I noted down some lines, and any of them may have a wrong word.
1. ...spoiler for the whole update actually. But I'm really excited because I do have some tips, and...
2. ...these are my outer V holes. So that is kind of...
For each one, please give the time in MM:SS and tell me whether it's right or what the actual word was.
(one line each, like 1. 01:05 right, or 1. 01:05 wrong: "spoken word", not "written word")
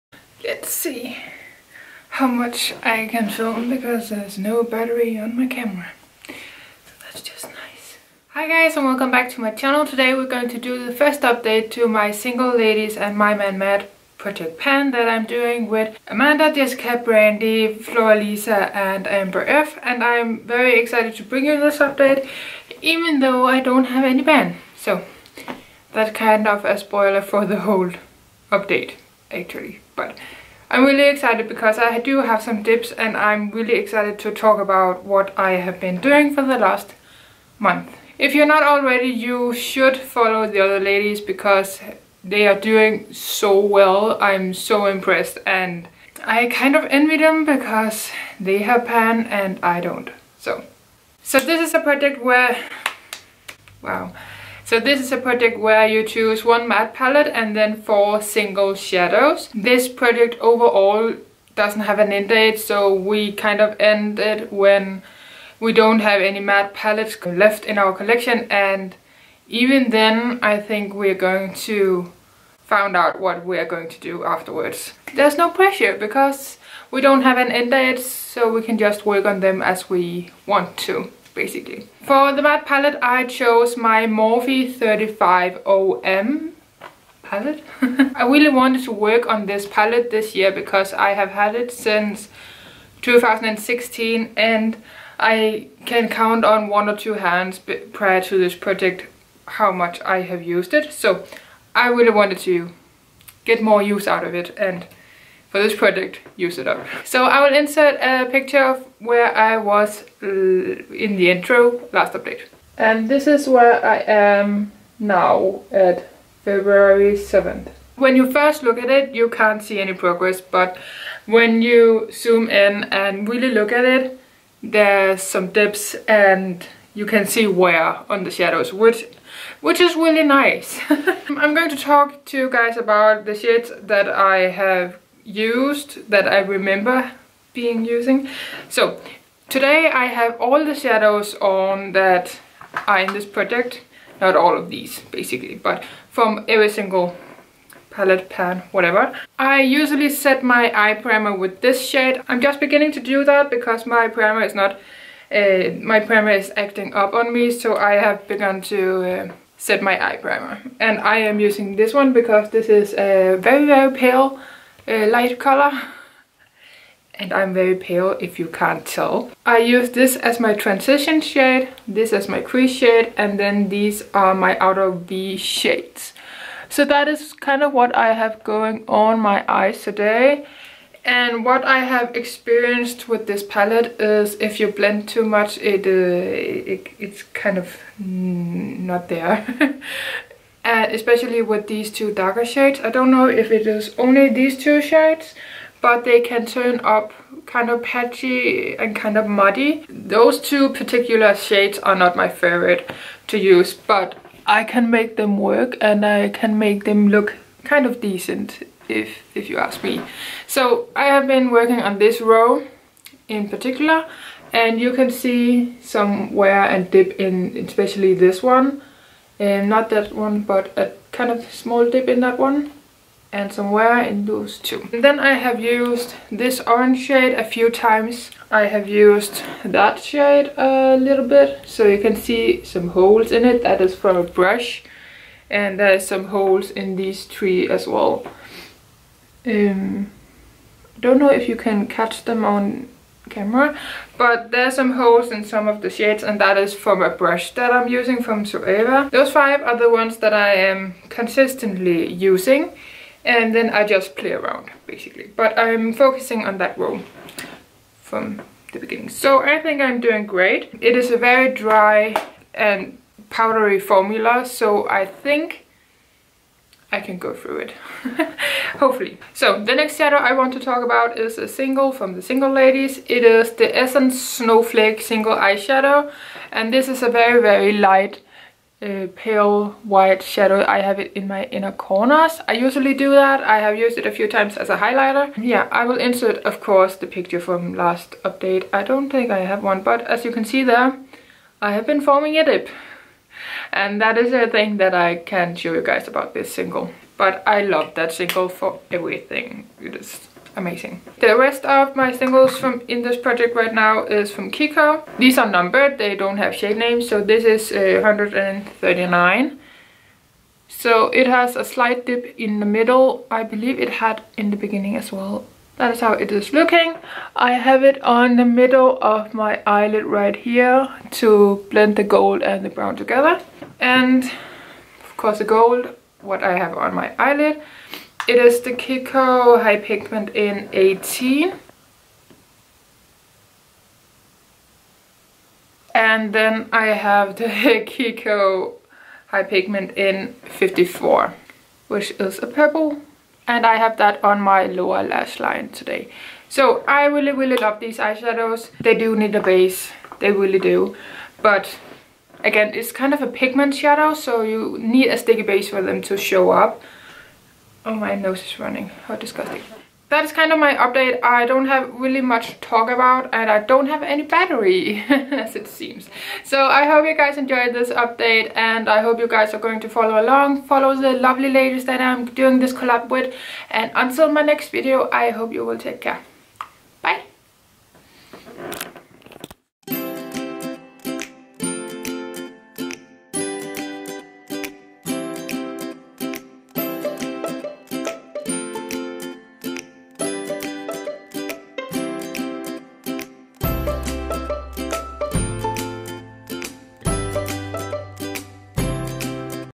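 1. 00:26 right
2. 02:53 wrong: "shades", not "holes".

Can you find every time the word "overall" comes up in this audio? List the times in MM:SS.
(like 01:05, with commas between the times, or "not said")
01:00.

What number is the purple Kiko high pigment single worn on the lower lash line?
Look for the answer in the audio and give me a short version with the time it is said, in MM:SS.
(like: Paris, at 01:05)
54, at 05:40.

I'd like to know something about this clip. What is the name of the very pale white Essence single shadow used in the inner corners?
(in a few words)
Snowflake.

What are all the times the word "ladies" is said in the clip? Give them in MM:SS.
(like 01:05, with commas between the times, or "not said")
00:12, 00:40, 04:32, 06:11.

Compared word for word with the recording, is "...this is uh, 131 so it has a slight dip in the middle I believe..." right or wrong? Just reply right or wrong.
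wrong.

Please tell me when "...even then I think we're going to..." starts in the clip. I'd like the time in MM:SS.
01:09.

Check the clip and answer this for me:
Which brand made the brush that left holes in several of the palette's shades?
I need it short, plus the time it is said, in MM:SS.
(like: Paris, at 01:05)
Zoeva, at 04:08.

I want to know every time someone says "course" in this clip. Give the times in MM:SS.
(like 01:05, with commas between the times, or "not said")
04:46, 05:25.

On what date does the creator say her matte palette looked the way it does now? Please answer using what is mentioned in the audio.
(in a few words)
February 7th.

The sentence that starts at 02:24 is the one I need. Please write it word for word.
Not all of these basically, but from every single palette, pan, whatever.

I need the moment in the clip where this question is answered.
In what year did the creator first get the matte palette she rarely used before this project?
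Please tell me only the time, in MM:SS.
01:33.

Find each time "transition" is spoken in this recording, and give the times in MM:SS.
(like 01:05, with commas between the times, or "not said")
02:50.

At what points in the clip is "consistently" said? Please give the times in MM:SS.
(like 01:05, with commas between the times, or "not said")
04:11.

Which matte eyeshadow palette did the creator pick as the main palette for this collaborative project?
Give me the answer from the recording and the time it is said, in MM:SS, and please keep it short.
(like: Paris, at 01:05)
Morphe 35OM, at 01:24.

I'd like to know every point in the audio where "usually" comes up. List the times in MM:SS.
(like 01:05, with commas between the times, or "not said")
02:29, 04:42.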